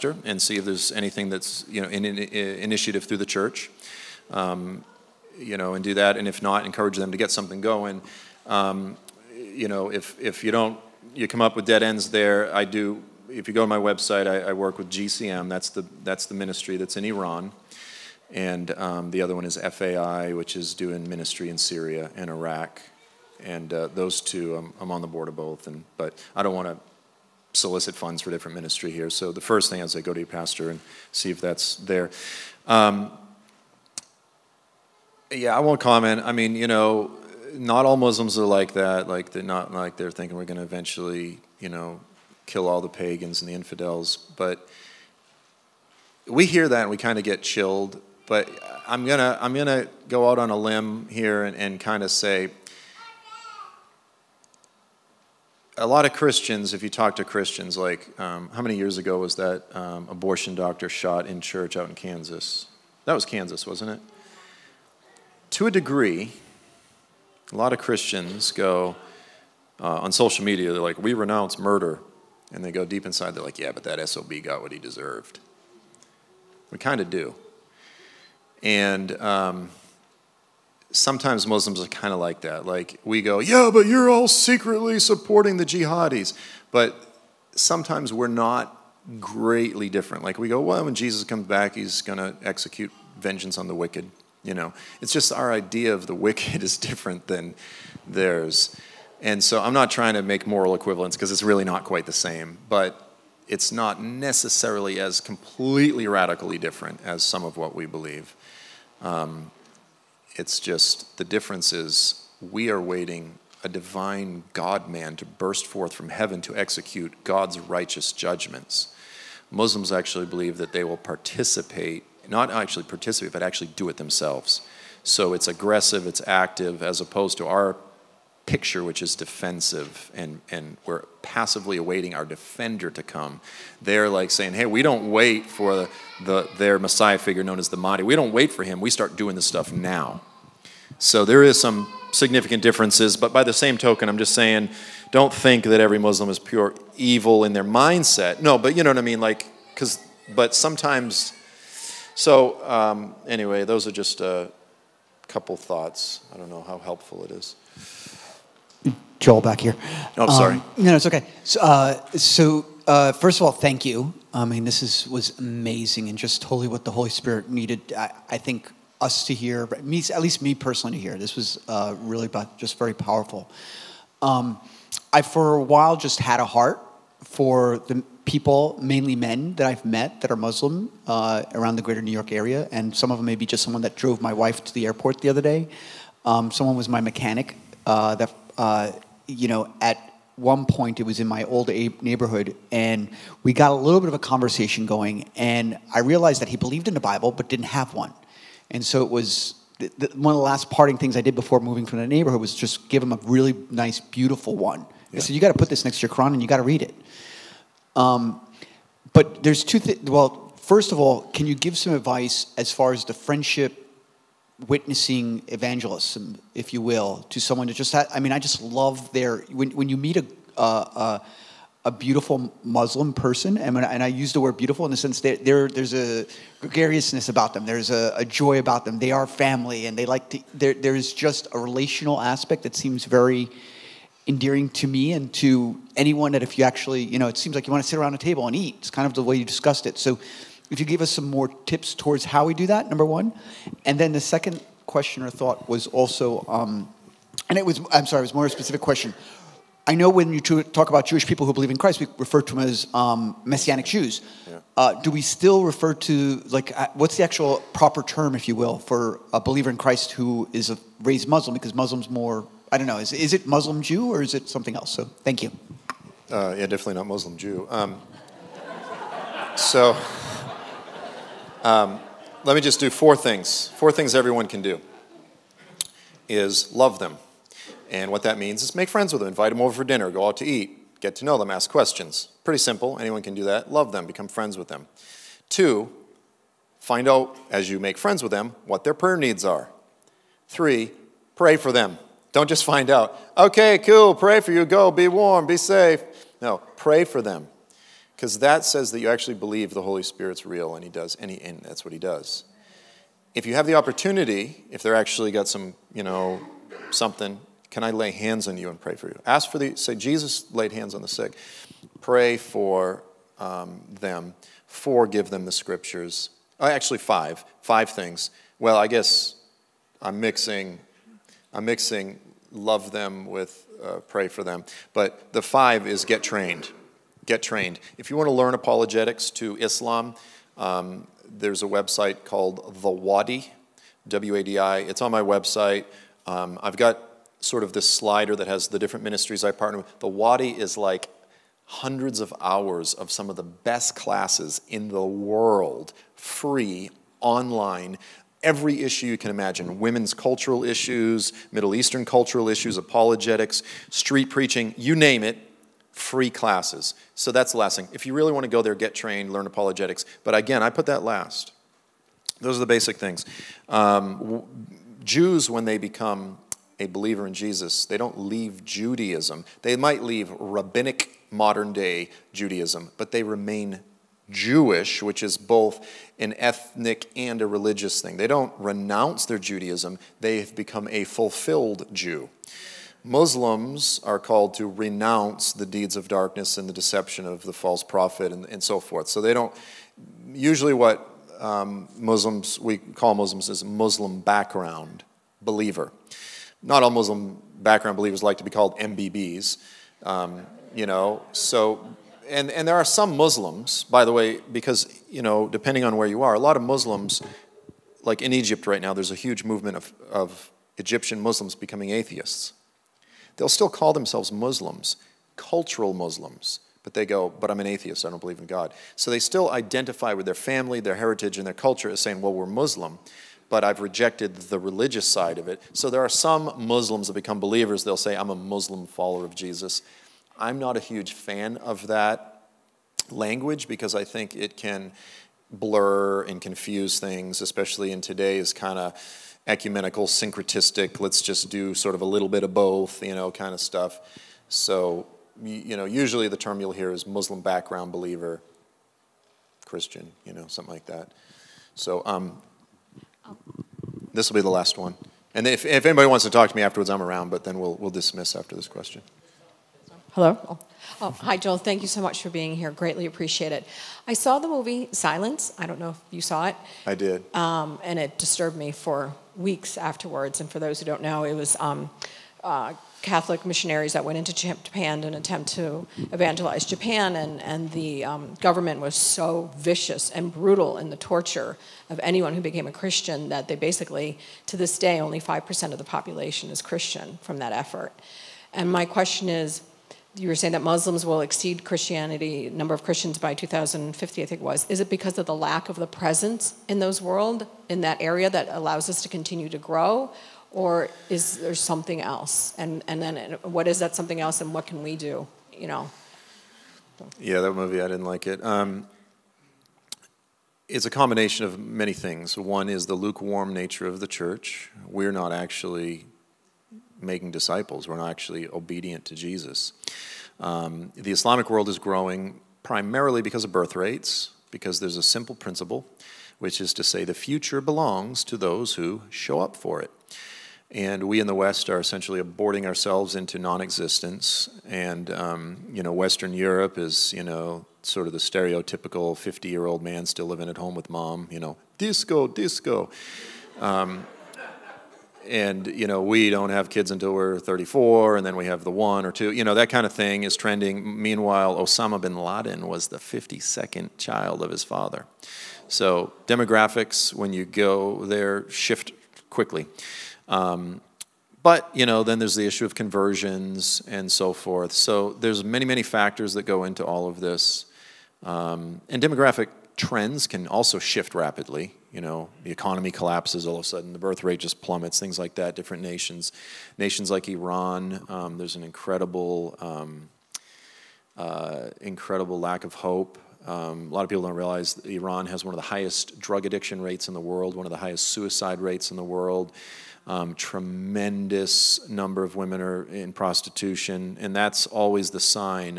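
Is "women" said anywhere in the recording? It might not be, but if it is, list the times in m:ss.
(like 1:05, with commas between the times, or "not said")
5:49, 9:52.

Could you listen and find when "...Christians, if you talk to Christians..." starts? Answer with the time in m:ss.
0:56.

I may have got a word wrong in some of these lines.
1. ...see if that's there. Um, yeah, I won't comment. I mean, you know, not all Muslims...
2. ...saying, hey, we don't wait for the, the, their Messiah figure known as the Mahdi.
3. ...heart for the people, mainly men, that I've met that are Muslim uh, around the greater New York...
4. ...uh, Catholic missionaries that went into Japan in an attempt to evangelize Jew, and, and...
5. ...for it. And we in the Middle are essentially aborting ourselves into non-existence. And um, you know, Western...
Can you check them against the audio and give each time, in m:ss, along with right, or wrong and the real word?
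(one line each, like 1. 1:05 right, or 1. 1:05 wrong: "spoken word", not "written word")
1. 0:31 right
2. 2:14 right
3. 2:56 right
4. 7:52 wrong: "Japan", not "Jew"
5. 8:49 wrong: "West", not "Middle".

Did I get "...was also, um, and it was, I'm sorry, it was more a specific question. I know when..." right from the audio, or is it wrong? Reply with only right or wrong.
right.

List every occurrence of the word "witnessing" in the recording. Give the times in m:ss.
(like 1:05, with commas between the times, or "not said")
3:34.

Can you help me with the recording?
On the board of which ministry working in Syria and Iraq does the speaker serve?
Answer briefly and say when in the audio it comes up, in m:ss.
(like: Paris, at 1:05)
FAI, at 0:19.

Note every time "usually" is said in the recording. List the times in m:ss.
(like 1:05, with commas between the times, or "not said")
6:30, 7:25.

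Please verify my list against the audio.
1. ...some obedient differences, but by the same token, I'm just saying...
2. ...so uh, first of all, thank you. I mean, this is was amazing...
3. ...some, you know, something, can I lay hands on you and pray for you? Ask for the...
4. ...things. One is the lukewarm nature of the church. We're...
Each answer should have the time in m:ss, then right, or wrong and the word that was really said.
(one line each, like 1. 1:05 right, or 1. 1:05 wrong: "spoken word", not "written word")
1. 2:21 wrong: "significant", not "obedient"
2. 2:42 right
3. 5:05 right
4. 8:31 right.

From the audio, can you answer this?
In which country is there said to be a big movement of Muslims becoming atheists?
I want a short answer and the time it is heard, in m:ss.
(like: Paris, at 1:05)
Egypt, at 6:48.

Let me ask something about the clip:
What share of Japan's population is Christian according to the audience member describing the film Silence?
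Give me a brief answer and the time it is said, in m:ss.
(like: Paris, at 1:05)
5%, at 8:05.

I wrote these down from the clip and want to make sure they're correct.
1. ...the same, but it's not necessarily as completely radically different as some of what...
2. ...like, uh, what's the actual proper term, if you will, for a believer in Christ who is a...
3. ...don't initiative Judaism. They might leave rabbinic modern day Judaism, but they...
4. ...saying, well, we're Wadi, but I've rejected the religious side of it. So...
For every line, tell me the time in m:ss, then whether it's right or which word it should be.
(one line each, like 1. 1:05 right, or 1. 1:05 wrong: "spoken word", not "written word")
1. 1:42 right
2. 4:16 right
3. 6:07 wrong: "leave", not "initiative"
4. 7:01 wrong: "Muslim", not "Wadi".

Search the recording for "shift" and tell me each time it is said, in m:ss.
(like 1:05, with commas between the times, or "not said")
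9:18, 9:30.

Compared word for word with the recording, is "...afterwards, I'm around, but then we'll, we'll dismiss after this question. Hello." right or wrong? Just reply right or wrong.
right.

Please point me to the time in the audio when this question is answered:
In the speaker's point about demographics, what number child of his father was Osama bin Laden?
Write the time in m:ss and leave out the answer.
9:12.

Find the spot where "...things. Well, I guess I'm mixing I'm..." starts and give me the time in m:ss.
5:17.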